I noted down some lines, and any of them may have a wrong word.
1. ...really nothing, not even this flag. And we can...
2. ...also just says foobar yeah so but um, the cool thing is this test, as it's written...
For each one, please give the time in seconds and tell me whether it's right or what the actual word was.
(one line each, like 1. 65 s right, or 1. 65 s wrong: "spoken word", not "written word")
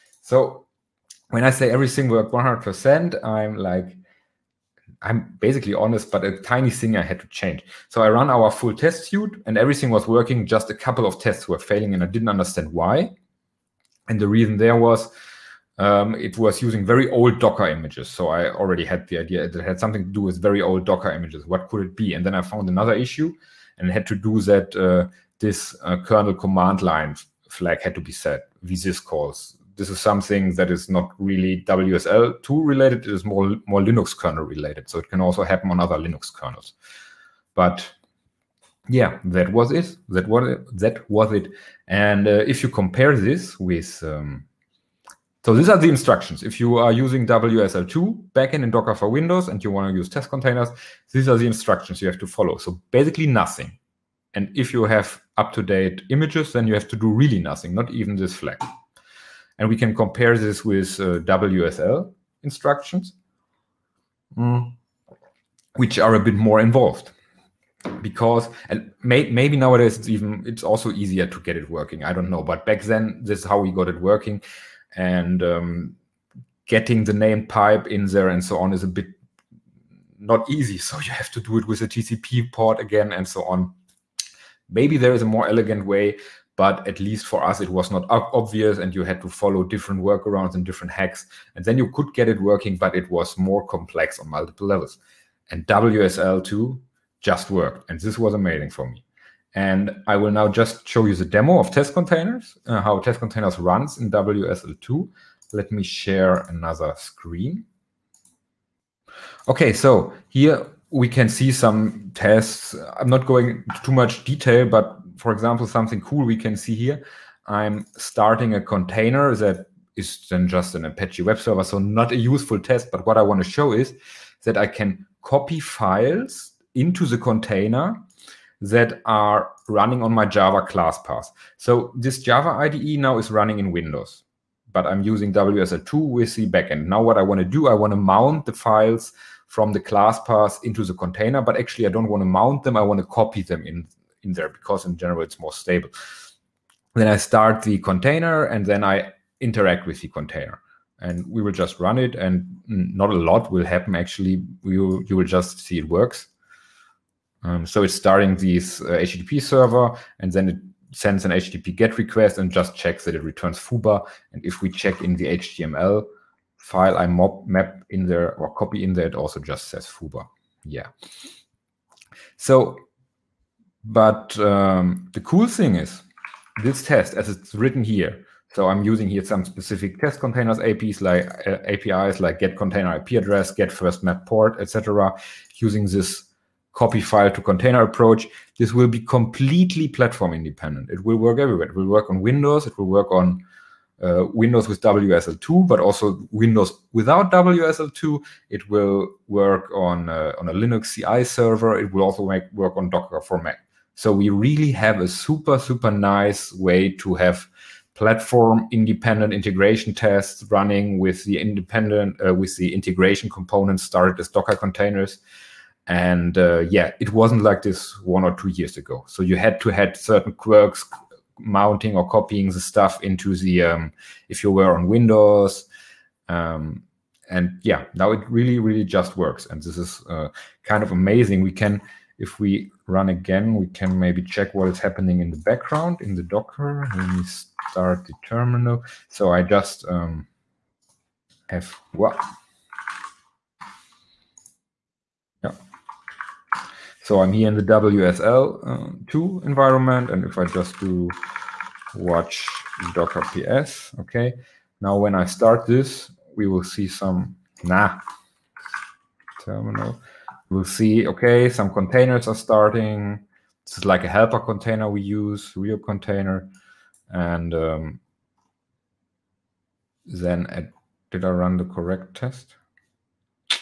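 1. 57 s right
2. 169 s right.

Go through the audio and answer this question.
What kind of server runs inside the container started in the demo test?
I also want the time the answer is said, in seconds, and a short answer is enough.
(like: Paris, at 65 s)
Apache web server, at 120 s.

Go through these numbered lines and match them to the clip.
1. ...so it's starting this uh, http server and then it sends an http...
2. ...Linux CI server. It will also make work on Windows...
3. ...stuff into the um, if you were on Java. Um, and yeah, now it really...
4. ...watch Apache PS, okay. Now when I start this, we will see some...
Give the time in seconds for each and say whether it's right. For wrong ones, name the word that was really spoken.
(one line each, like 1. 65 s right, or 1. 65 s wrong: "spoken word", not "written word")
1. 157 s right
2. 200 s wrong: "Docker", not "Windows"
3. 222 s wrong: "Windows", not "Java"
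4. 251 s wrong: "Docker", not "Apache".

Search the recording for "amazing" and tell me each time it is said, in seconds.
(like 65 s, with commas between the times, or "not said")
98 s, 230 s.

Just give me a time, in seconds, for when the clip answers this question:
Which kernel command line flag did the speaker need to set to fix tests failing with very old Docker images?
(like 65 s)
28 s.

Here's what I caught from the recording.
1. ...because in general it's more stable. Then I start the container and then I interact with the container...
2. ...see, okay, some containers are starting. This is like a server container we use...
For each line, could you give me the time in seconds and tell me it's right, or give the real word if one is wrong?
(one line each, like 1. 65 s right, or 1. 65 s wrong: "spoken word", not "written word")
1. 144 s right
2. 260 s wrong: "helper", not "server".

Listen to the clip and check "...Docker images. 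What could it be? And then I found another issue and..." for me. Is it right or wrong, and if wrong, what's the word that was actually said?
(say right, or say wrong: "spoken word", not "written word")
right.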